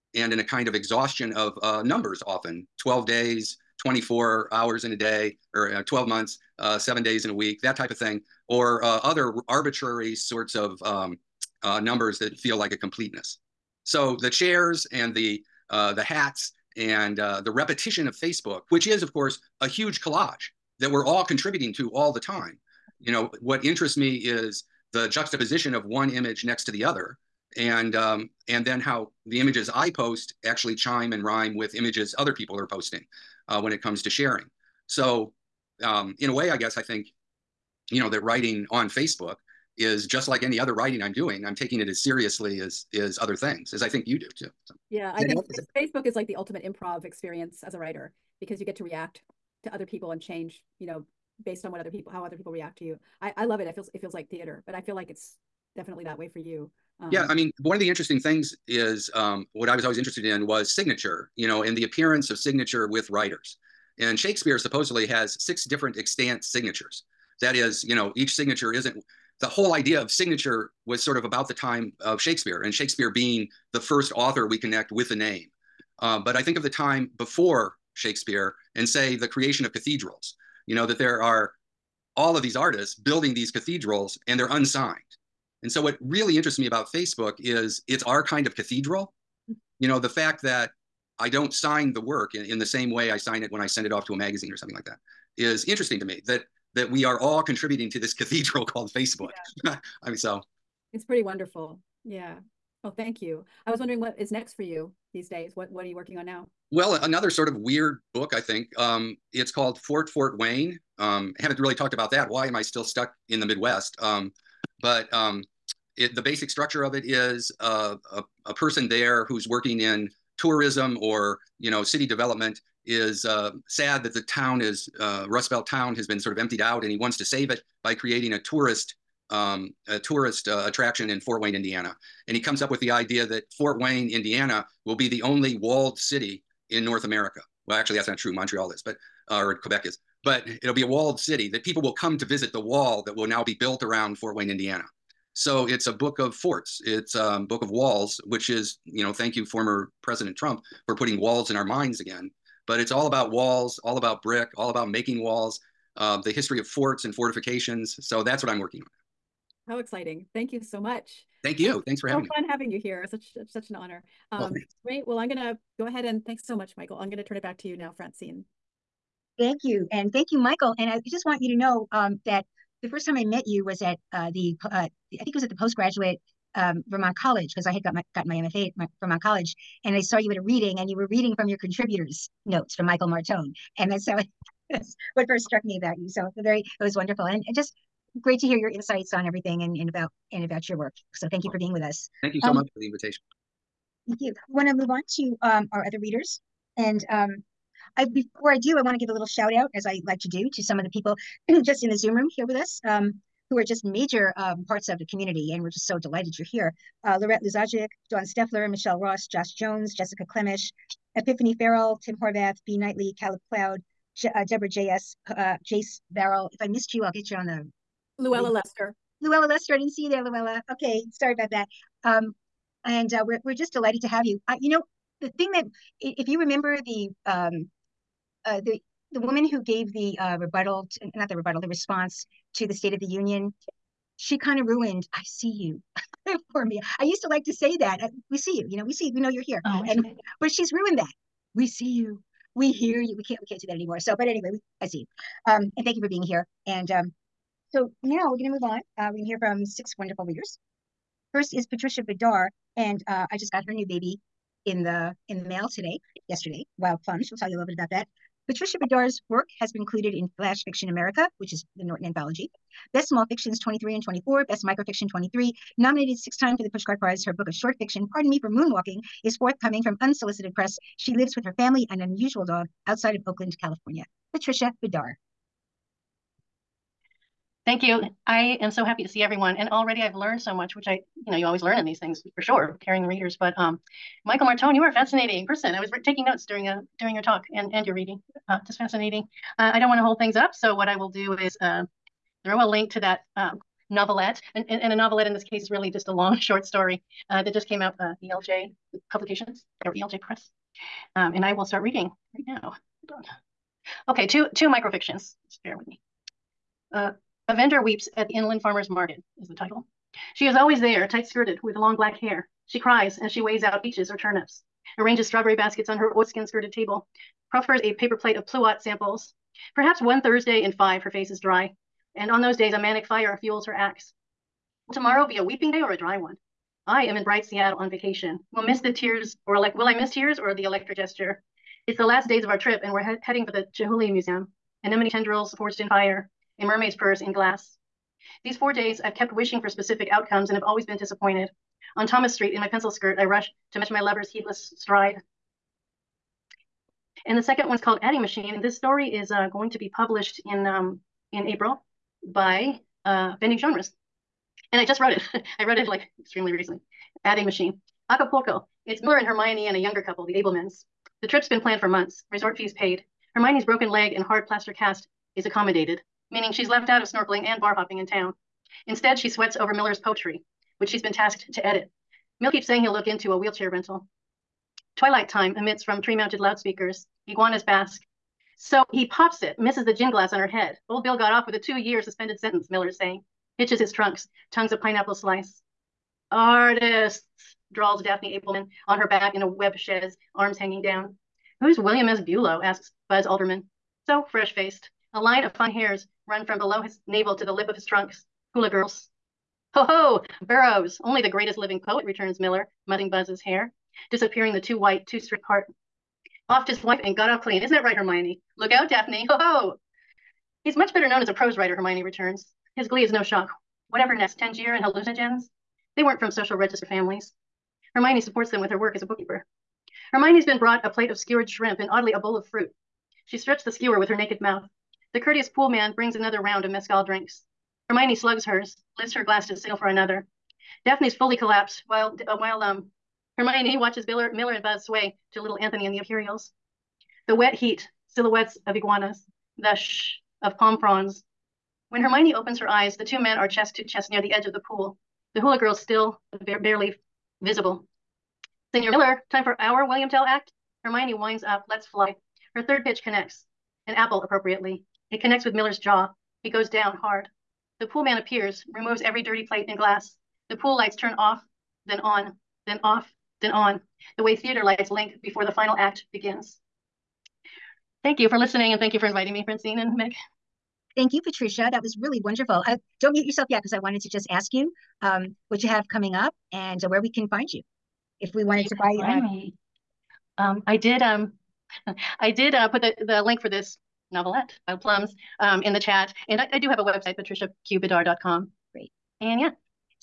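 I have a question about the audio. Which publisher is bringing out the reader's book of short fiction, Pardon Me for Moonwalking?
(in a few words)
Unsolicited Press.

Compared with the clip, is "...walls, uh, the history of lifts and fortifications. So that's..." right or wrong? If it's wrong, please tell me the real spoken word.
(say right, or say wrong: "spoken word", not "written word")
wrong: "forts", not "lifts".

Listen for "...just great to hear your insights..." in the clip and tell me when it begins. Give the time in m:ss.
3:07.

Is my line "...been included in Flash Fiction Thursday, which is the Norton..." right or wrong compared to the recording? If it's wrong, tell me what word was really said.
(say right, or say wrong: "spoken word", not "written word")
wrong: "America", not "Thursday".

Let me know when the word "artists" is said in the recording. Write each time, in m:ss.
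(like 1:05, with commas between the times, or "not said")
1:22, 6:26.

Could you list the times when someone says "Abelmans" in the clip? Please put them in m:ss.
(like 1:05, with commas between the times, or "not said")
6:00, 6:28.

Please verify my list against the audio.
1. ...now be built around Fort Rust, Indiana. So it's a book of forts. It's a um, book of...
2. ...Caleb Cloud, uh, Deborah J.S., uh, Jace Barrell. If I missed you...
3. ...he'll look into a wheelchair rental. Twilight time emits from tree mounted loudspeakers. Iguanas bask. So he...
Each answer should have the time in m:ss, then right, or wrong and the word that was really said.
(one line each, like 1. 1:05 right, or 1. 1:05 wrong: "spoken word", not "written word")
1. 2:23 wrong: "Wayne", not "Rust"
2. 3:33 right
3. 6:12 right.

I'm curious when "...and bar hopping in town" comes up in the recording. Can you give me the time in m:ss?
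6:07.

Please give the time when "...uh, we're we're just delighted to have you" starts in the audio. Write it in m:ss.
3:43.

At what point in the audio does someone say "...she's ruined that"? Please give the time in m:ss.
4:00.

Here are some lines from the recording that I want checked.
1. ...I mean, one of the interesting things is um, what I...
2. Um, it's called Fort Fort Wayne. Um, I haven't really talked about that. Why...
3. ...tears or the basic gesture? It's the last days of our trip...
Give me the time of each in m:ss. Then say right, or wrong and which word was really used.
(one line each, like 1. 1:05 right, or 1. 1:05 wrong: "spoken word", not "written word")
1. 0:57 right
2. 1:48 right
3. 5:30 wrong: "electric", not "basic".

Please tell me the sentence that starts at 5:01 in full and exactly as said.
Um, and I will start reading right now.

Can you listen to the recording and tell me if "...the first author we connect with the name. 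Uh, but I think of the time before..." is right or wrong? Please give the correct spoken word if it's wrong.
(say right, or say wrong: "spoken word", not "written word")
right.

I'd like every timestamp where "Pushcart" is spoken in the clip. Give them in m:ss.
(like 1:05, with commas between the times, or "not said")
4:26.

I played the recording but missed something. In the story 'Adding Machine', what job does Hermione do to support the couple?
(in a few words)
Bookkeeper.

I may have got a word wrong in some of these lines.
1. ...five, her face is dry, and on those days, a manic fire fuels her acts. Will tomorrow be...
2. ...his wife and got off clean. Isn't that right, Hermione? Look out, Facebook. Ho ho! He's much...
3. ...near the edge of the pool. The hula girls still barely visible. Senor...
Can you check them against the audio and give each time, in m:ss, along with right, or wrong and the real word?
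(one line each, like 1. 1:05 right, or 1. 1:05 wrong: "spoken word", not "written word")
1. 5:20 right
2. 6:46 wrong: "Daphne", not "Facebook"
3. 7:24 right.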